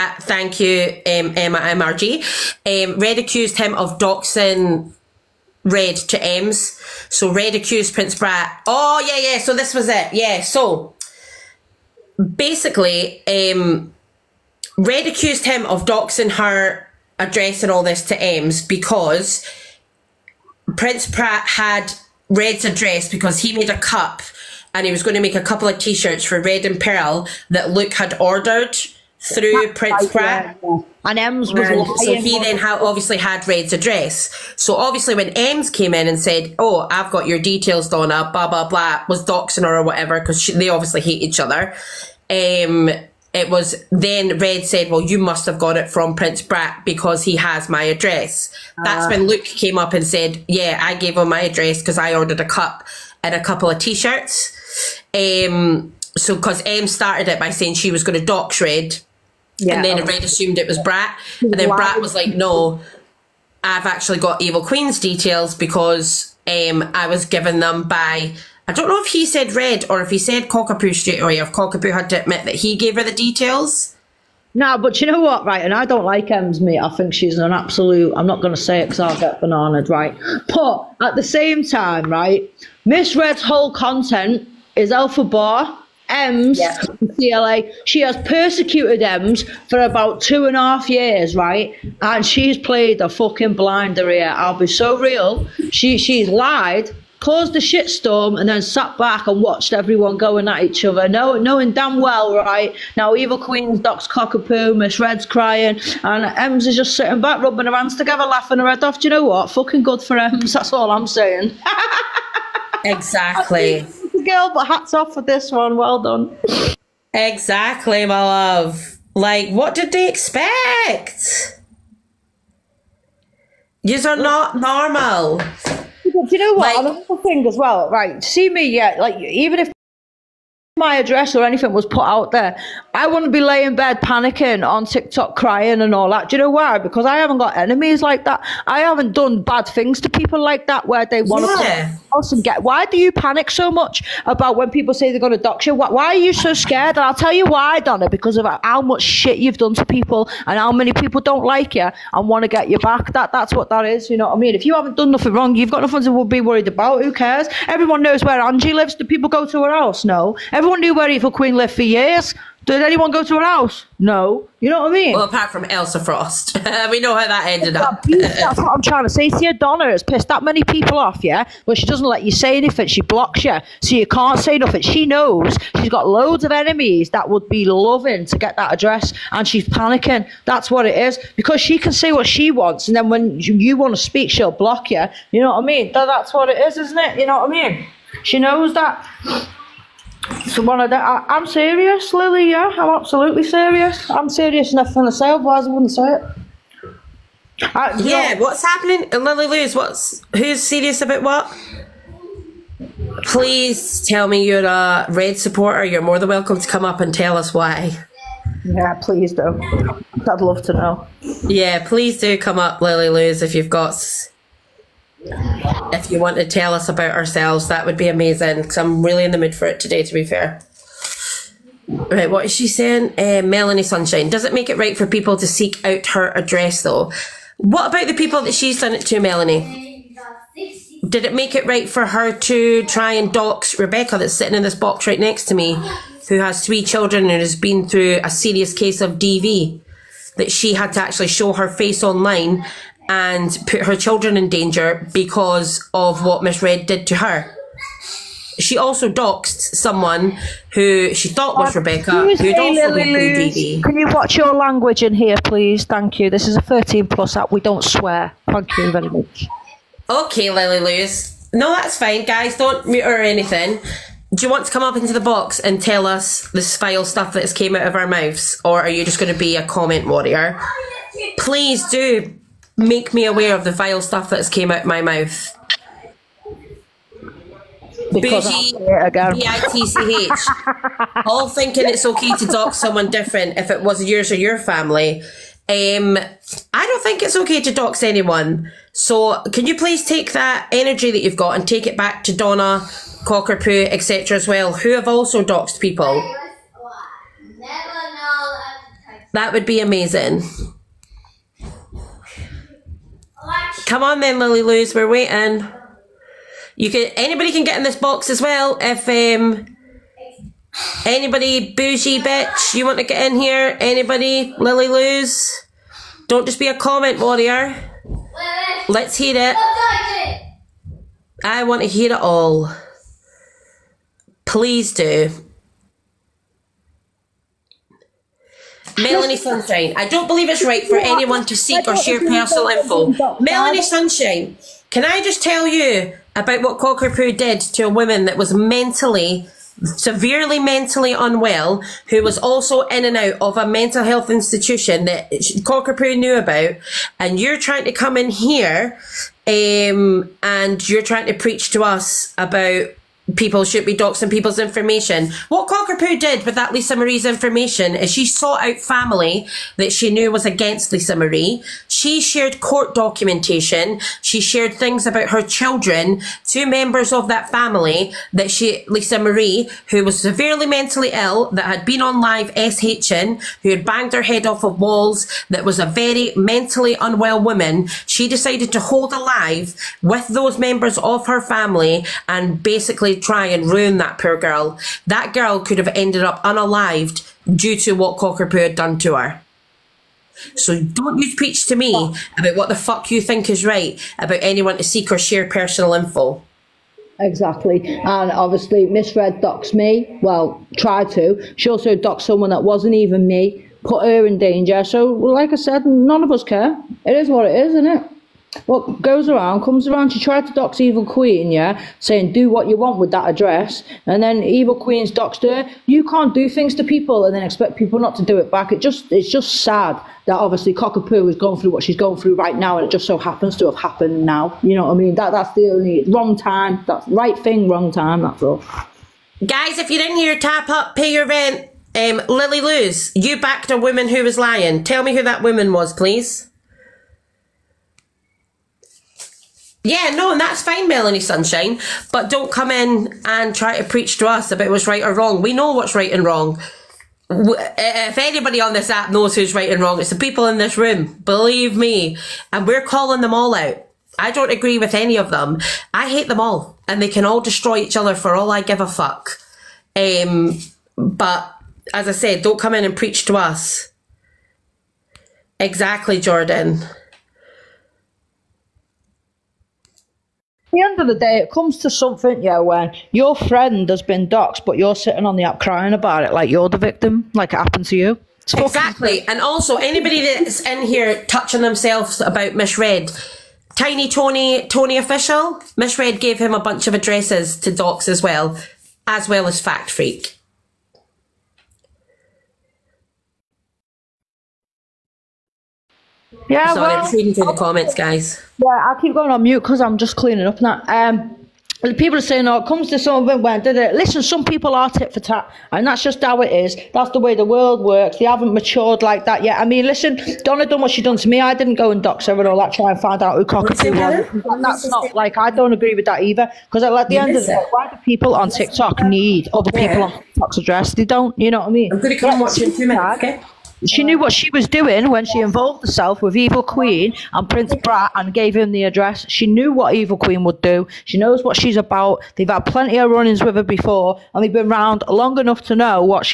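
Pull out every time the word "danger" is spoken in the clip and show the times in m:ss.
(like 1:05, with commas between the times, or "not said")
4:04, 6:44.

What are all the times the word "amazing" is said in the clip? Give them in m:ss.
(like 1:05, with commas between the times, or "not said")
3:38, 4:59.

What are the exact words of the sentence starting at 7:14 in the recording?
Tell me who that woman was, please.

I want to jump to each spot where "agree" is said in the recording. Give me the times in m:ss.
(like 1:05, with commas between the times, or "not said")
7:34, 8:35.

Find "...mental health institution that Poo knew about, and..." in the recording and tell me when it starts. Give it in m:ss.
5:43.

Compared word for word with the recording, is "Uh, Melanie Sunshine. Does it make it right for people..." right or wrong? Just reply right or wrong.
right.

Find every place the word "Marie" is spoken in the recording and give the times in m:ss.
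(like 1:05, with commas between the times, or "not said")
5:56, 6:01, 6:09.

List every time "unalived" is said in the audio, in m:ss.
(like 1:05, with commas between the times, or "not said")
6:26.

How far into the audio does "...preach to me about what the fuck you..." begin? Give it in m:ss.
6:31.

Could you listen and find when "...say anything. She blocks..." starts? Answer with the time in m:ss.
2:52.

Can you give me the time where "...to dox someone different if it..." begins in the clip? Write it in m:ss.
4:42.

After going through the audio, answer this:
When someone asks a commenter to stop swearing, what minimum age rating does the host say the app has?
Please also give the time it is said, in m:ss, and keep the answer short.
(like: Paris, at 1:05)
13 plus, at 4:16.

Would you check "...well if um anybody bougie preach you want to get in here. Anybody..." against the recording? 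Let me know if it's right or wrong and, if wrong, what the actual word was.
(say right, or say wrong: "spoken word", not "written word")
wrong: "bitch", not "preach".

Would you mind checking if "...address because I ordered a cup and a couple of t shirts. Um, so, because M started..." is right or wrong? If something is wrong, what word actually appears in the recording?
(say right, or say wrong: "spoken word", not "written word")
right.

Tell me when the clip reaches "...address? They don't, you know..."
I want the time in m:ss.
8:40.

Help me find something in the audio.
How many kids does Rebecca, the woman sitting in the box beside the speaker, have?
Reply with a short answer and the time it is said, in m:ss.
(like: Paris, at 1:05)
3, at 3:56.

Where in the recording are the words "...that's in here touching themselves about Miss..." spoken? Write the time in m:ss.
8:00.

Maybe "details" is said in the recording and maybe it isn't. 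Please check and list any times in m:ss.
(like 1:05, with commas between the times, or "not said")
0:37, 1:04, 1:13.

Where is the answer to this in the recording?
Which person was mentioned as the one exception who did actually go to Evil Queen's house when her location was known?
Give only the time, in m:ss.
2:45.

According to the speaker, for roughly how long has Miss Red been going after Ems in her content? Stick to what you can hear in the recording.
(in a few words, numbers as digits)
2 and a half years.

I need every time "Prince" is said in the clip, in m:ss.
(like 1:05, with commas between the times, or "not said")
0:07, 0:20, 0:29, 0:46, 8:47.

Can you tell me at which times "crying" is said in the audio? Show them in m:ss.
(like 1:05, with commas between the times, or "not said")
1:45, 2:15, 7:55.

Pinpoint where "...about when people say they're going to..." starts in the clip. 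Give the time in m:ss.
2:24.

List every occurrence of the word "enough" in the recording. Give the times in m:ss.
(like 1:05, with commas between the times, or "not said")
3:14, 8:55.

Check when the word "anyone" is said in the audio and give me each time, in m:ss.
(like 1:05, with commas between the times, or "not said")
2:42, 4:48, 5:30, 6:34.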